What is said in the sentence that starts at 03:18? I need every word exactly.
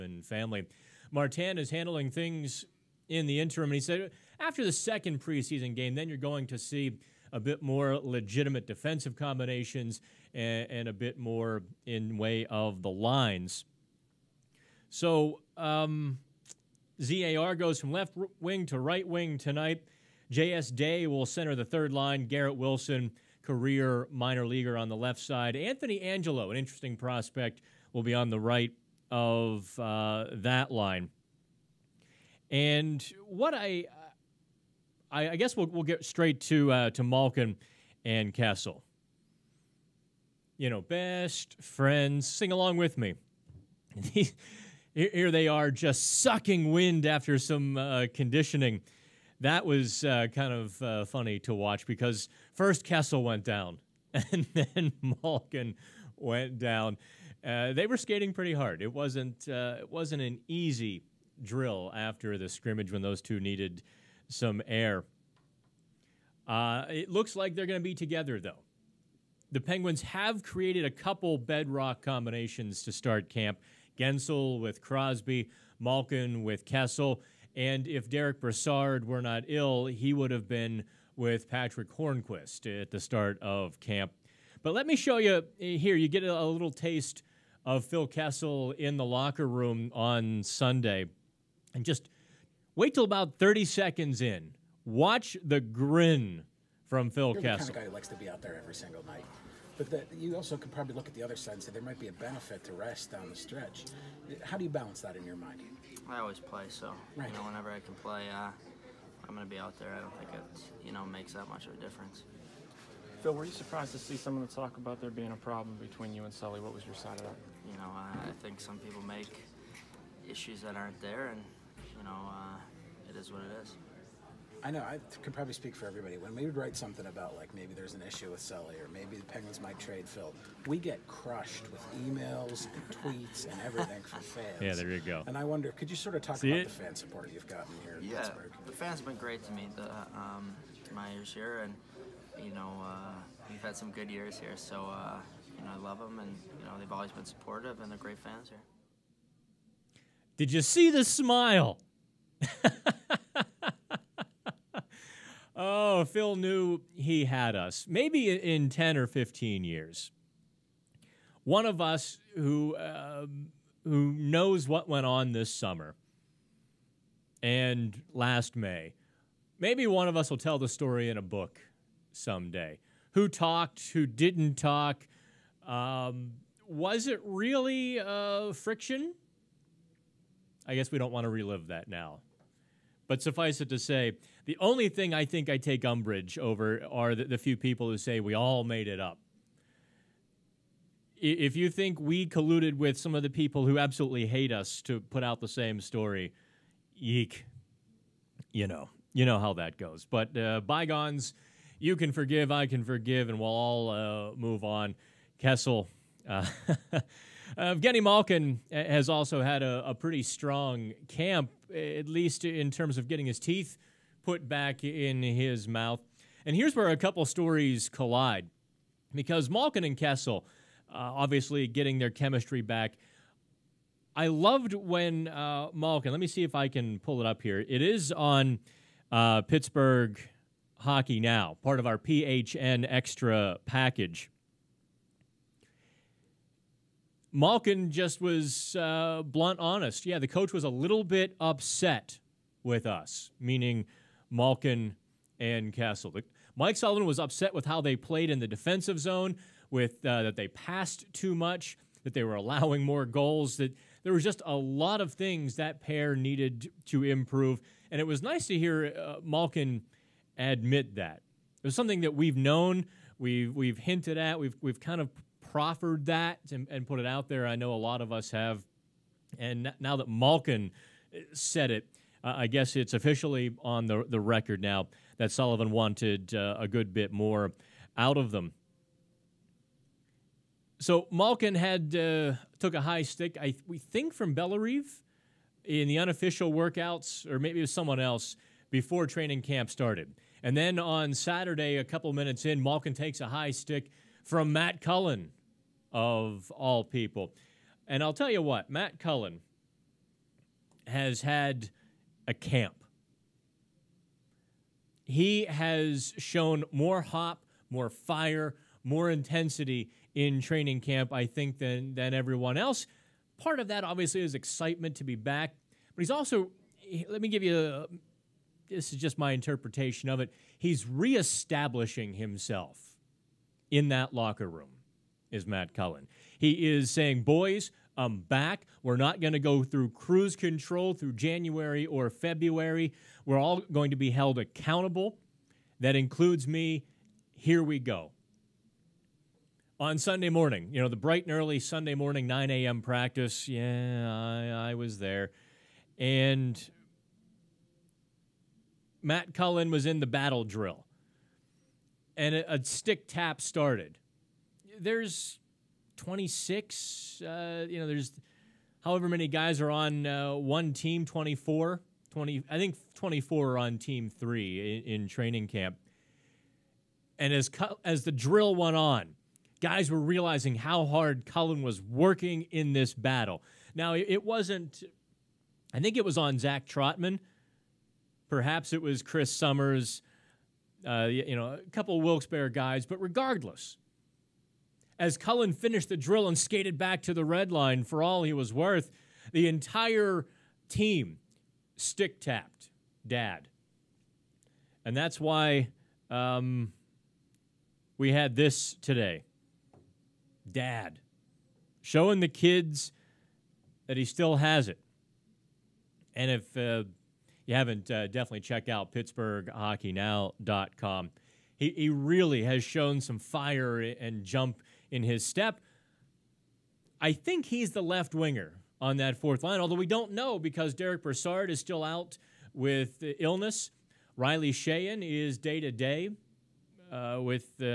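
You know, you know how that goes.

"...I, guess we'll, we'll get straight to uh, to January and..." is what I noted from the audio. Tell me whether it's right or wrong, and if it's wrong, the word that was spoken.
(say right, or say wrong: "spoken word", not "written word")
wrong: "Malkin", not "January".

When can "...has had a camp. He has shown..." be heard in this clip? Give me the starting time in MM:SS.
05:00.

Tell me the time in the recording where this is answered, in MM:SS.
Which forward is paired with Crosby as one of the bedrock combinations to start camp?
01:13.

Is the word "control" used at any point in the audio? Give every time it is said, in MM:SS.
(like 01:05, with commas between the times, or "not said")
05:30.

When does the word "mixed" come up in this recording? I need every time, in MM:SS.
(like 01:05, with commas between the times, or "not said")
not said.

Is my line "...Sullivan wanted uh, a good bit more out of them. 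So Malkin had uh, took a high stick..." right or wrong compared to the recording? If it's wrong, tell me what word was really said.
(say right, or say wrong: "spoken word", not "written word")
right.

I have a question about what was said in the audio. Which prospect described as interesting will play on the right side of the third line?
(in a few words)
Anthony Angello.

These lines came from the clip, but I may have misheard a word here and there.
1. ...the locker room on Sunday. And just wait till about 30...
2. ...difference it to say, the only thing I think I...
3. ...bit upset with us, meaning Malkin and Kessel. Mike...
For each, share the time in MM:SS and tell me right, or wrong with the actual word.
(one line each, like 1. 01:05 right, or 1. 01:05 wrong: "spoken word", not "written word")
1. 01:28 right
2. 03:03 wrong: "suffice", not "difference"
3. 04:01 right.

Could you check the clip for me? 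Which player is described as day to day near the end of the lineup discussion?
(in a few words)
Riley Sheahan.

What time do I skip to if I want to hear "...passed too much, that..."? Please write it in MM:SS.
04:10.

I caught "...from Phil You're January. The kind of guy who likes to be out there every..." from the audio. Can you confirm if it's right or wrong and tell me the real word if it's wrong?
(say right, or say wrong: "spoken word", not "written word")
wrong: "Kessel", not "January".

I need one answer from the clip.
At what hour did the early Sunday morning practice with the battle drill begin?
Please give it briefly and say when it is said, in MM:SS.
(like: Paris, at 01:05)
9 a.m., at 05:42.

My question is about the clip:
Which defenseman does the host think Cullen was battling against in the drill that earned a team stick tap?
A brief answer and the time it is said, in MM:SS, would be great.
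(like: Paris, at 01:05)
Zach Trotman, at 06:16.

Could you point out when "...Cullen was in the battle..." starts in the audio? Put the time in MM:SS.
05:49.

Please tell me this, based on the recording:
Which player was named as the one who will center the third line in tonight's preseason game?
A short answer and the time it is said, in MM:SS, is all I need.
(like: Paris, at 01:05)
J.S. Dea, at 00:20.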